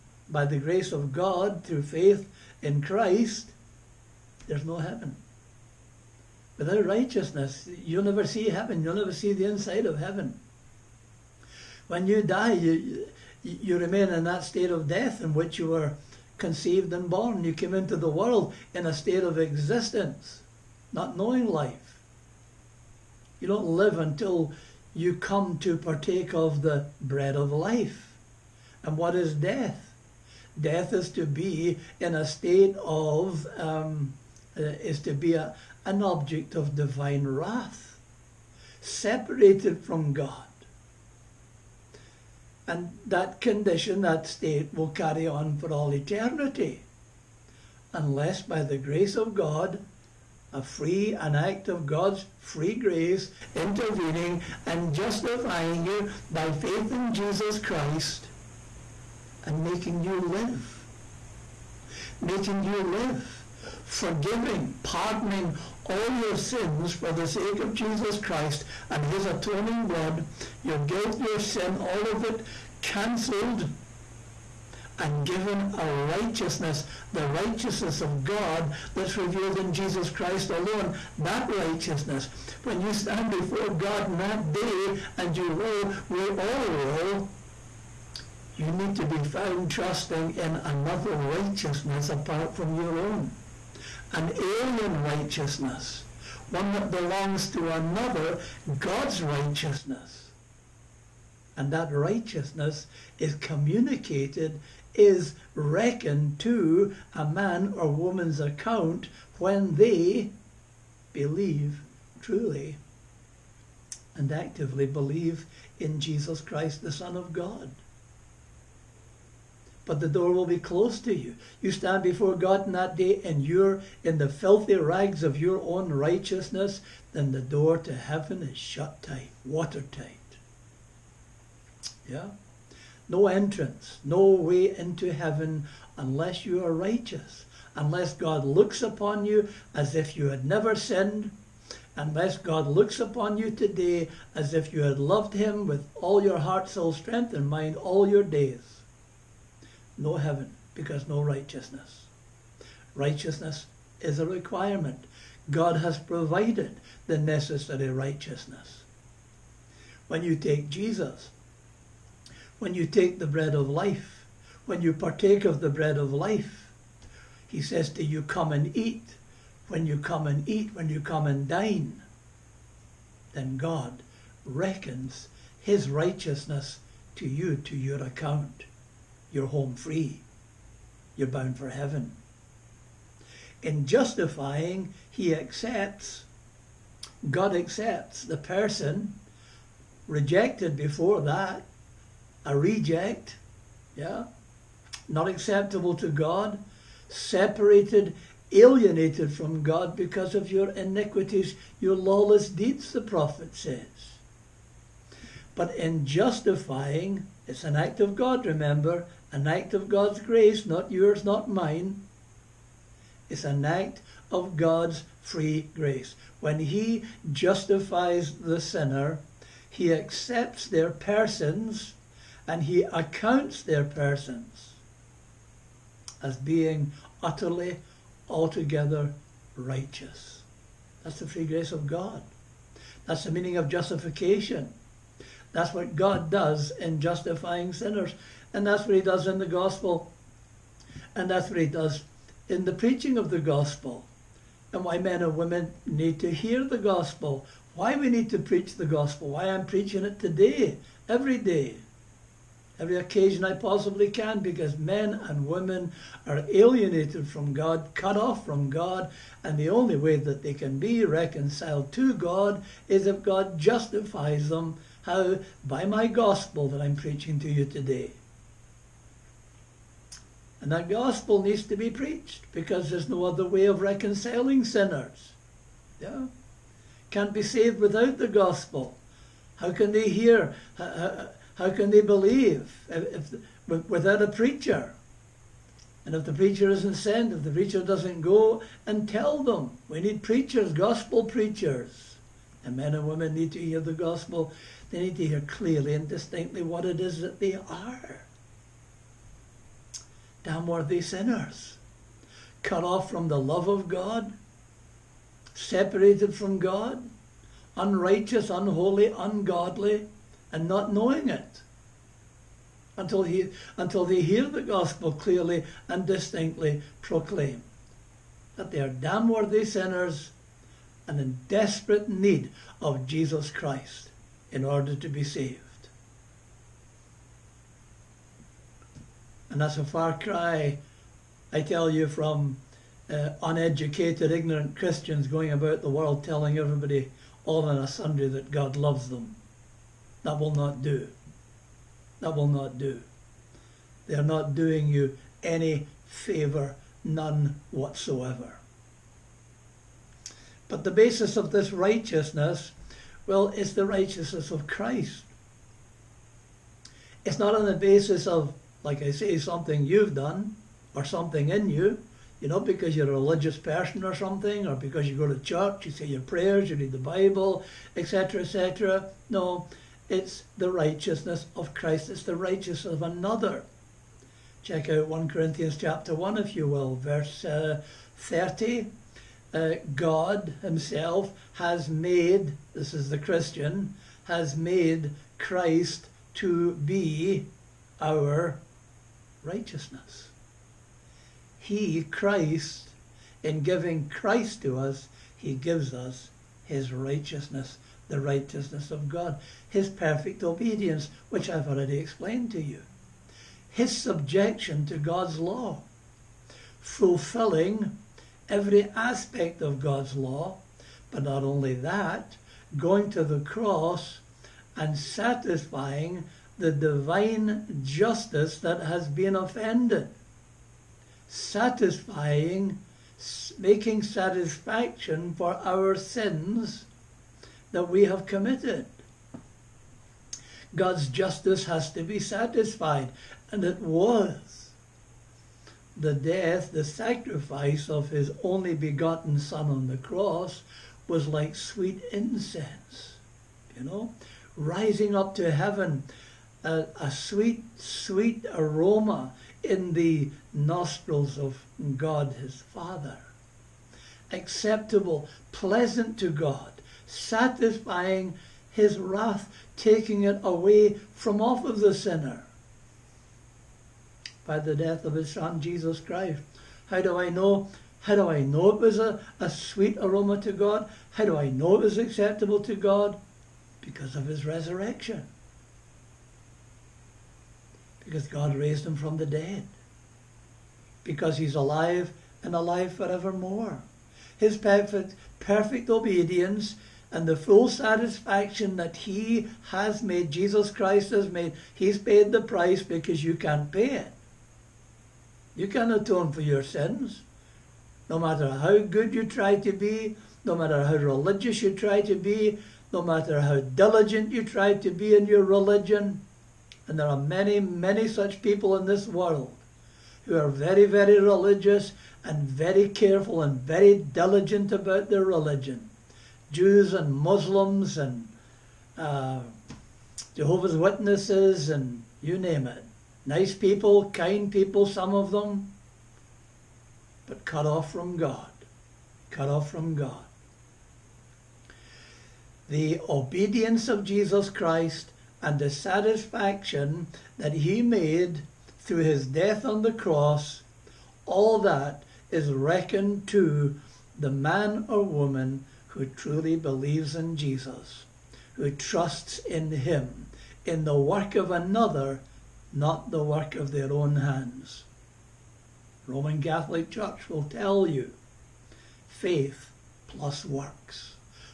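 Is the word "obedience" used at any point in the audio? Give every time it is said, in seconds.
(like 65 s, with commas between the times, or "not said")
400 s, 485 s, 533 s.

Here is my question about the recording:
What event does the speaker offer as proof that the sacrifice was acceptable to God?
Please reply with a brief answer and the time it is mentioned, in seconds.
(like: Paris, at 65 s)
His resurrection, at 474 s.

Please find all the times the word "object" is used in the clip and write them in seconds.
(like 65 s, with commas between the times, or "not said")
36 s.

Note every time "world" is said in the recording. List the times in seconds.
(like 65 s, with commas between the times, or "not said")
18 s, 335 s, 509 s.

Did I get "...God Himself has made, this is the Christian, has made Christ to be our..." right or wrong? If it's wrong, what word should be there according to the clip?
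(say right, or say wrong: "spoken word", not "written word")
right.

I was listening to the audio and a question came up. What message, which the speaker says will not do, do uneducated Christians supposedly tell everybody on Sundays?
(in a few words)
God loves them.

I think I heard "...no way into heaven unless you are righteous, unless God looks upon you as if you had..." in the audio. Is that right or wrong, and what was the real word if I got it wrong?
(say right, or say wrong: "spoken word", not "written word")
right.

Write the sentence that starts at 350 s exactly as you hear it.
But the basis of this righteousness well, it's the righteousness of Christ.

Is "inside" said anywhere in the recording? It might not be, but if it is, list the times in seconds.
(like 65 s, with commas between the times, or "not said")
9 s.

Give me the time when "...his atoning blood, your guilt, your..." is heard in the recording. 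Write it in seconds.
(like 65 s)
69 s.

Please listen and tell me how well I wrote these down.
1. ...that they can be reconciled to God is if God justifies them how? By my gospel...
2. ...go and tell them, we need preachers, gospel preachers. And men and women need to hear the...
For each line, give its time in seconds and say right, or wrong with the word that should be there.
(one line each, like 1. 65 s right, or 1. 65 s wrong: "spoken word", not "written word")
1. 260 s right
2. 288 s right.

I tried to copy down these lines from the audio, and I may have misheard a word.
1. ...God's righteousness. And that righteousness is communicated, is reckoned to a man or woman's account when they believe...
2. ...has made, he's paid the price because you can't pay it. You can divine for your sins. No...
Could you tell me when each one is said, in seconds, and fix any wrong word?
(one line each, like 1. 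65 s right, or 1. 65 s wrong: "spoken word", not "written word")
1. 98 s right
2. 491 s wrong: "atone", not "divine".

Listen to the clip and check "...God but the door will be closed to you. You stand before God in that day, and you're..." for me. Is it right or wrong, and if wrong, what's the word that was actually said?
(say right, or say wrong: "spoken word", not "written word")
right.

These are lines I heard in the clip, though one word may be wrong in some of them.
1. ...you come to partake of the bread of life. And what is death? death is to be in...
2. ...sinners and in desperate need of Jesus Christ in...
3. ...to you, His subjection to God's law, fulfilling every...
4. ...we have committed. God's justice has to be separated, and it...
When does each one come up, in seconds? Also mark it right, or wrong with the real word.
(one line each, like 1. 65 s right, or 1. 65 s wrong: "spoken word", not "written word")
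1. 24 s right
2. 319 s right
3. 402 s right
4. 427 s wrong: "satisfied", not "separated".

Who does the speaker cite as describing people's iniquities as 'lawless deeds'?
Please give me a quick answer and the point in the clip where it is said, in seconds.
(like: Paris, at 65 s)
The prophet, at 202 s.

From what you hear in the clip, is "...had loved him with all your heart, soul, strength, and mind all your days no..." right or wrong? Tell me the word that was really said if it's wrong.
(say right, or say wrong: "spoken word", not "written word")
right.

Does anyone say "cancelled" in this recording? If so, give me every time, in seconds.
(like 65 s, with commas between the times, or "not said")
72 s.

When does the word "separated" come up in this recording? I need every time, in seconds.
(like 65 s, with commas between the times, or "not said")
38 s, 197 s, 305 s.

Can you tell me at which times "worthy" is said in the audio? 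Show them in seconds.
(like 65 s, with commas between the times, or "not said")
300 s, 319 s.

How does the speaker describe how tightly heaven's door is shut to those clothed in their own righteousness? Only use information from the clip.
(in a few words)
Watertight.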